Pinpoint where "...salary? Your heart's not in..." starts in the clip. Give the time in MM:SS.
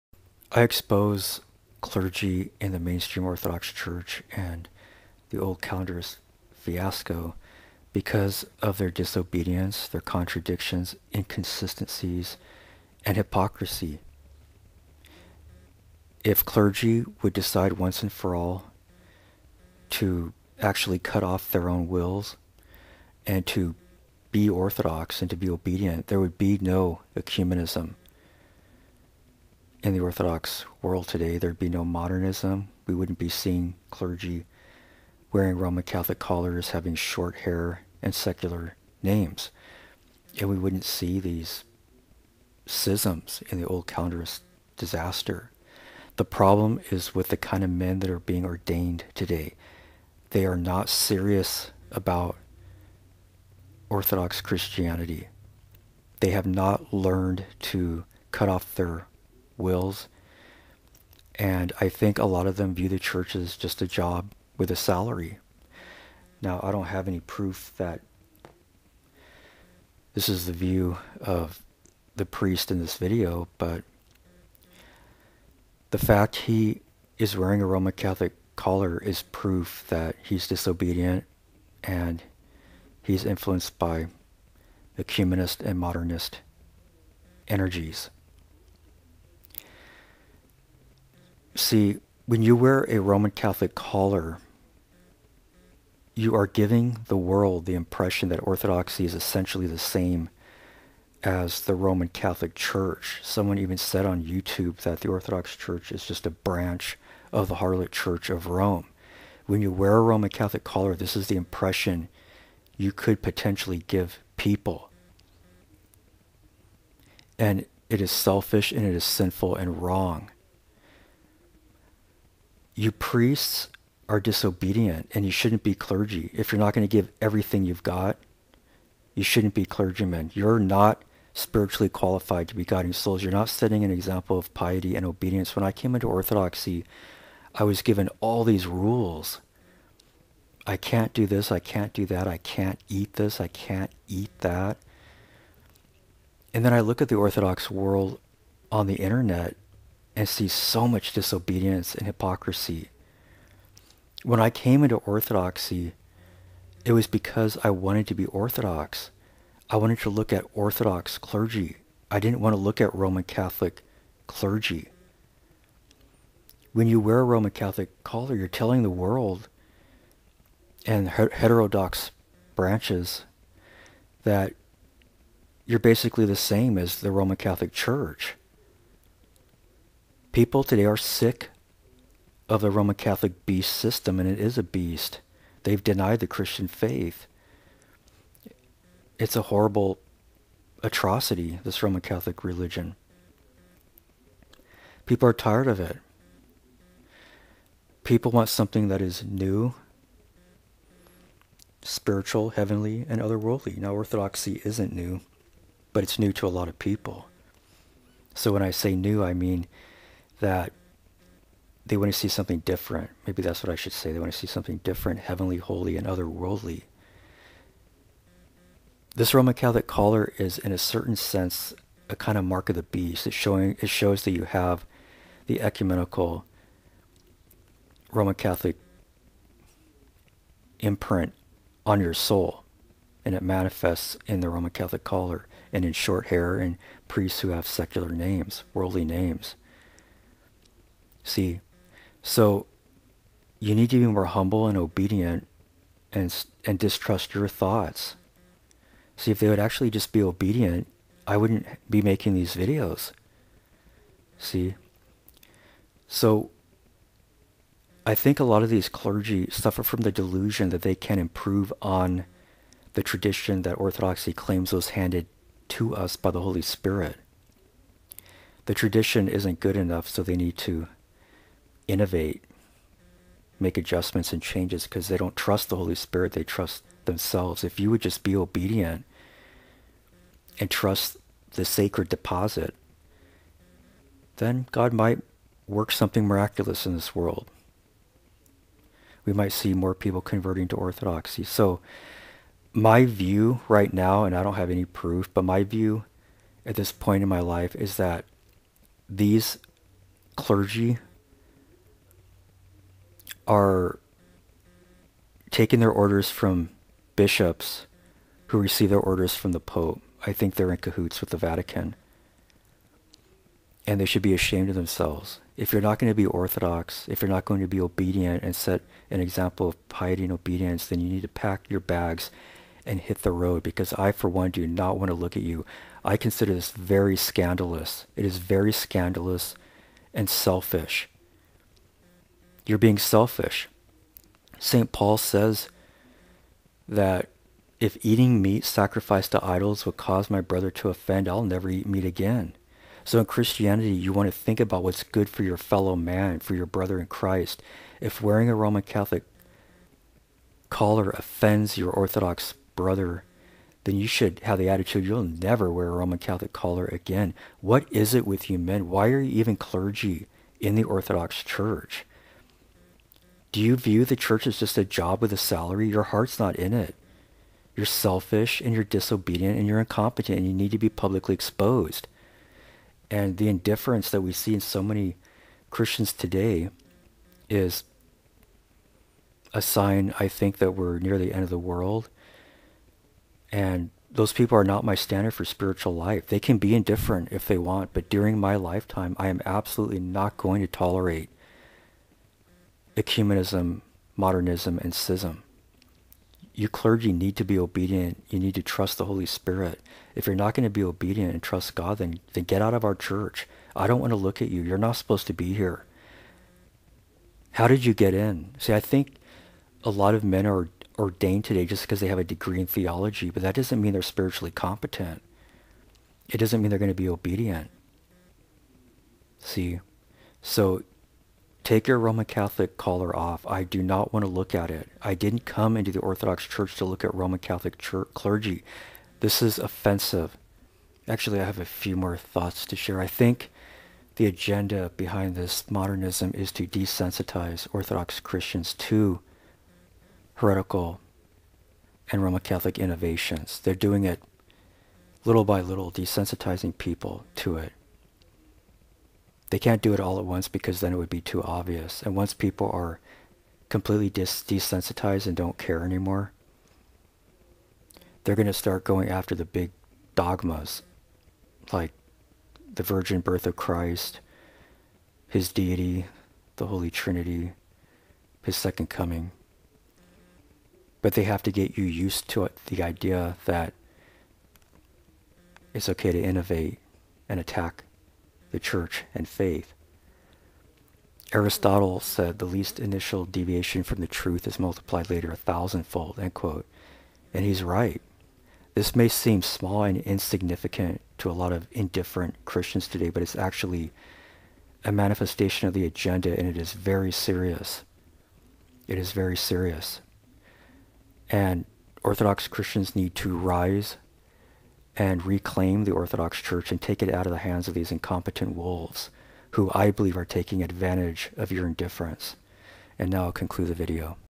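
06:05.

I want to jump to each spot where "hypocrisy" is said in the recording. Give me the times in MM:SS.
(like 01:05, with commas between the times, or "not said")
00:13, 02:32.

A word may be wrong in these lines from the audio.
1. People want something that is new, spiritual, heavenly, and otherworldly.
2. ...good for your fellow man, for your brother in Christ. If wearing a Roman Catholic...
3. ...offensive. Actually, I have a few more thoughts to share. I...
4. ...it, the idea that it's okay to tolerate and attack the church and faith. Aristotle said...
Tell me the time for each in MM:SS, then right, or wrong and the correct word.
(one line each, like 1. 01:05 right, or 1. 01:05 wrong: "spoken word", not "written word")
1. 03:18 right
2. 05:45 right
3. 07:09 right
4. 07:52 wrong: "innovate", not "tolerate".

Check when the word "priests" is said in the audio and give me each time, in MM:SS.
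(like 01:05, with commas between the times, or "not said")
01:12, 02:02, 03:57.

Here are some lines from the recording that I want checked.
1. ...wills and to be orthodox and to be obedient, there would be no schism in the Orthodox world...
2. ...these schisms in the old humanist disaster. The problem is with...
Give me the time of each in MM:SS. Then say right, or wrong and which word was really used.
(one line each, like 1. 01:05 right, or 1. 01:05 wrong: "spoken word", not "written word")
1. 00:21 wrong: "ecumenism", not "schism"
2. 00:41 wrong: "calendarist", not "humanist".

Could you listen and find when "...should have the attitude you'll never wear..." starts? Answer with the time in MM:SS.
05:54.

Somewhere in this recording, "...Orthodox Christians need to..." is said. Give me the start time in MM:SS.
08:22.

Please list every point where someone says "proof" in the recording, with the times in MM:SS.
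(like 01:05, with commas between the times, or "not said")
01:07, 01:19, 04:54.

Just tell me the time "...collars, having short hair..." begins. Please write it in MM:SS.
00:36.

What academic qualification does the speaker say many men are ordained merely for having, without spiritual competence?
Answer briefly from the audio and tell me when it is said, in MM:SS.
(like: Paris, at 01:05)
a degree in theology, at 06:52.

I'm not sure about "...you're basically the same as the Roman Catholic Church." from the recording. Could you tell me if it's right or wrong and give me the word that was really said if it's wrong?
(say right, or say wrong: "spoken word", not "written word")
right.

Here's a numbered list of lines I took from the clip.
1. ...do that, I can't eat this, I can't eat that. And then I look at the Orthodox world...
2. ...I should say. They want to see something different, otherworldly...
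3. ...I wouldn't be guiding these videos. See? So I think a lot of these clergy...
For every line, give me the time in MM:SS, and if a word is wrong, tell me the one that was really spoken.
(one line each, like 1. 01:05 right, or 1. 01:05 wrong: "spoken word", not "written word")
1. 02:21 right
2. 03:33 wrong: "heavenly", not "otherworldly"
3. 04:11 wrong: "making", not "guiding".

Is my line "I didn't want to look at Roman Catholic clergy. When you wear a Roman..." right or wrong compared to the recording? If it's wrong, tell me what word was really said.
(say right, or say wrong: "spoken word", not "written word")
right.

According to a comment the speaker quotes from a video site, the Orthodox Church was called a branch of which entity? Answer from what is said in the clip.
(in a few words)
Harlot Church of Rome.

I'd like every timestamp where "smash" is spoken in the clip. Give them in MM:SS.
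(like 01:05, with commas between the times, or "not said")
not said.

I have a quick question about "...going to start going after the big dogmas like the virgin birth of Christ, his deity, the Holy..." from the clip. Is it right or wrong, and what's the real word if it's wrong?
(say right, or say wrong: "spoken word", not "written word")
right.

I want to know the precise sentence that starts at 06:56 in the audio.
It doesn't mean they're going to be obedient.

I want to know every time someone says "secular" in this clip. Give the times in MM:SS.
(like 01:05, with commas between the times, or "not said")
00:38, 03:57.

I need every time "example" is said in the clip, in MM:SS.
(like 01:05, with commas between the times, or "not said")
02:13, 05:19.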